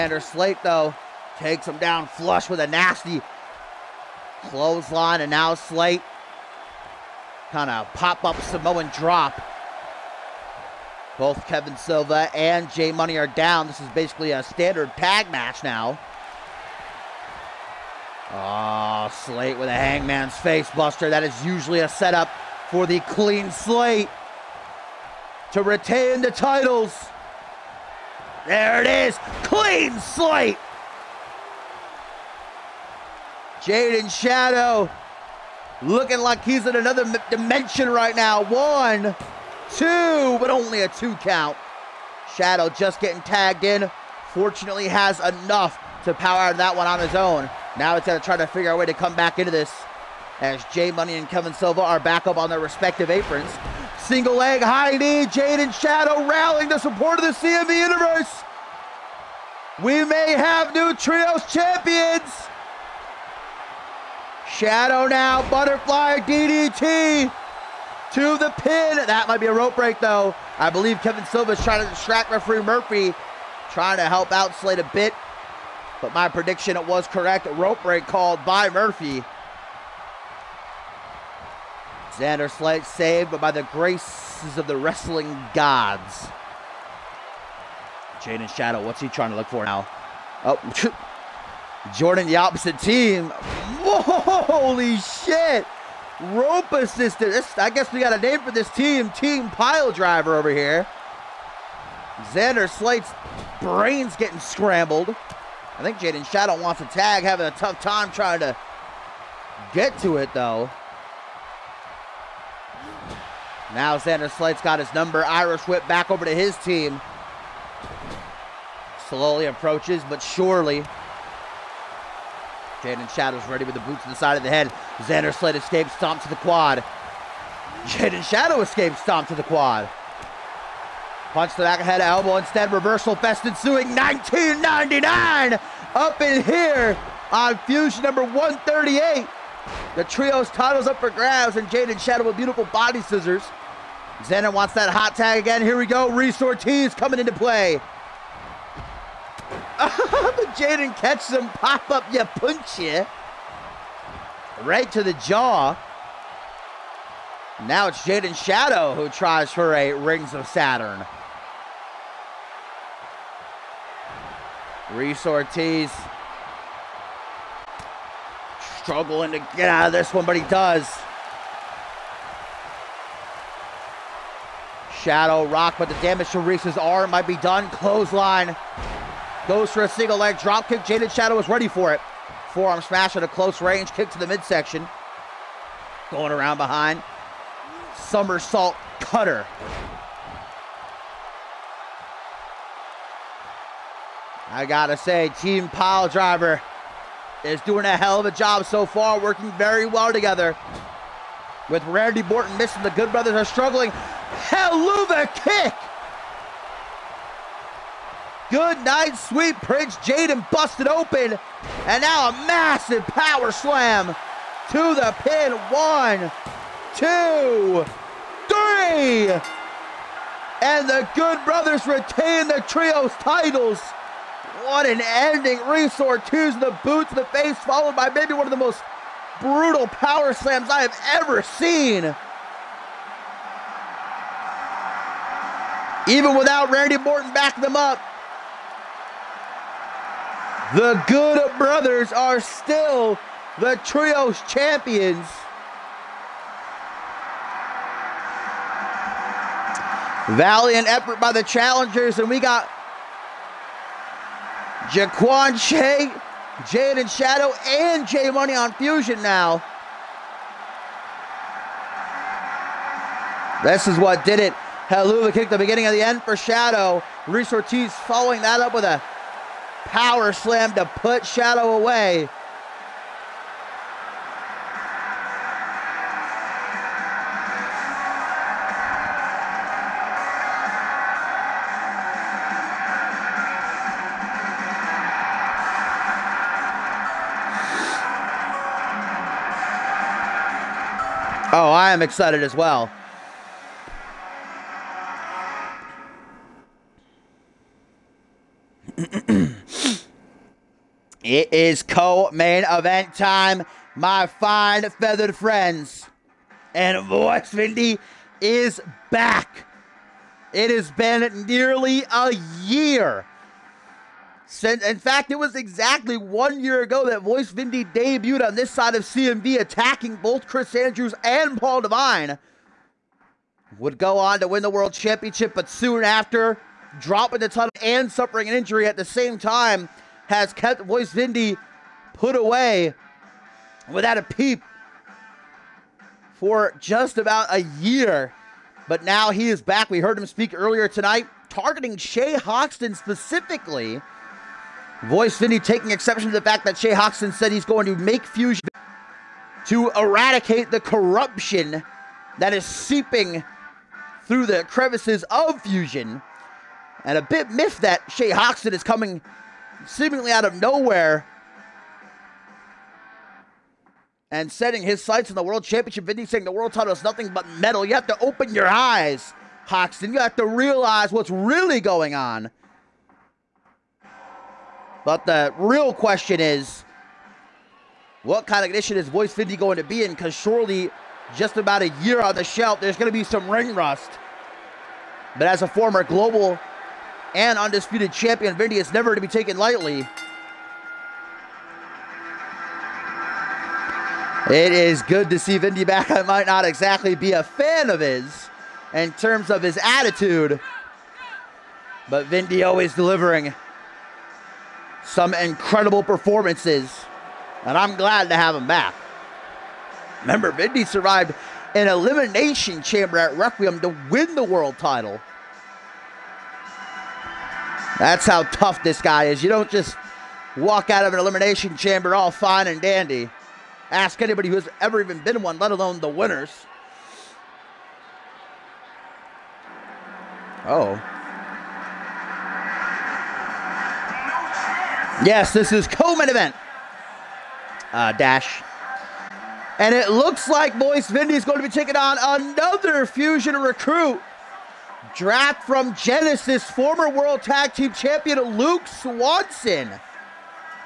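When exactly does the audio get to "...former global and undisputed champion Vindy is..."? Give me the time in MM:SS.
06:25.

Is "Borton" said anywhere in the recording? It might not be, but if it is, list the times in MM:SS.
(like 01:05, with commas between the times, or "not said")
03:22, 03:56.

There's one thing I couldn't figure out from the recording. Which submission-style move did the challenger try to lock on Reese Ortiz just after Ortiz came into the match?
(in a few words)
Rings of Saturn.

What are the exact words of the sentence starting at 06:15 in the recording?
But the real question is, what kind of condition is Voice Vindy going to be in?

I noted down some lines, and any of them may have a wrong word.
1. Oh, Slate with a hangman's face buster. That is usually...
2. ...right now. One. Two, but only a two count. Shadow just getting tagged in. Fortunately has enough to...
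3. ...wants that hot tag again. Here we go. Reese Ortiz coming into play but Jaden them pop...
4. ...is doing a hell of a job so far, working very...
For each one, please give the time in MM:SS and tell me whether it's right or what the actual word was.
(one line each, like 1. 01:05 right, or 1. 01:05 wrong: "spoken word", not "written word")
1. 00:18 right
2. 00:37 right
3. 02:24 right
4. 03:17 right.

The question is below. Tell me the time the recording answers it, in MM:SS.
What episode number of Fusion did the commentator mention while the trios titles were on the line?
02:18.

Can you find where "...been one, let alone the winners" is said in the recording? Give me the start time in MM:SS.
07:05.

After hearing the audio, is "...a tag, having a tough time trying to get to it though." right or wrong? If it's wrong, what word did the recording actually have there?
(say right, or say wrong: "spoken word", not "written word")
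right.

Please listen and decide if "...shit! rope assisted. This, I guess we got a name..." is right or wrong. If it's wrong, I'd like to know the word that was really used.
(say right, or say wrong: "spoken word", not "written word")
right.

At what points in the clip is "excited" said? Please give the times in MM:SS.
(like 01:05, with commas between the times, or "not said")
04:52.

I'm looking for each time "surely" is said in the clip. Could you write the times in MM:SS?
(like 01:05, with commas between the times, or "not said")
02:00, 06:20.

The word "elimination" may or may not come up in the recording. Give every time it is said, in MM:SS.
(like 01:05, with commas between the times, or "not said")
06:51, 07:01.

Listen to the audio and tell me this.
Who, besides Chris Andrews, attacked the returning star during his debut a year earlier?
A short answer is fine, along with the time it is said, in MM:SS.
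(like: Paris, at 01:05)
Paul Devine, at 05:21.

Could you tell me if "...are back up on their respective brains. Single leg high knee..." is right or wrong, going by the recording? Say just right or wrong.
wrong.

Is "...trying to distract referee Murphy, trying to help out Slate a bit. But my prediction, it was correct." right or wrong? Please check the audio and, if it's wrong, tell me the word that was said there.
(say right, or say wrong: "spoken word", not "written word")
right.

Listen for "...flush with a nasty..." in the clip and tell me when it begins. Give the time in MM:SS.
00:02.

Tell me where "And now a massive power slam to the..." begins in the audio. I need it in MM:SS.
03:31.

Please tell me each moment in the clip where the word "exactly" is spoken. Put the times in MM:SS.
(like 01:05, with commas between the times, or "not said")
05:15, 06:36.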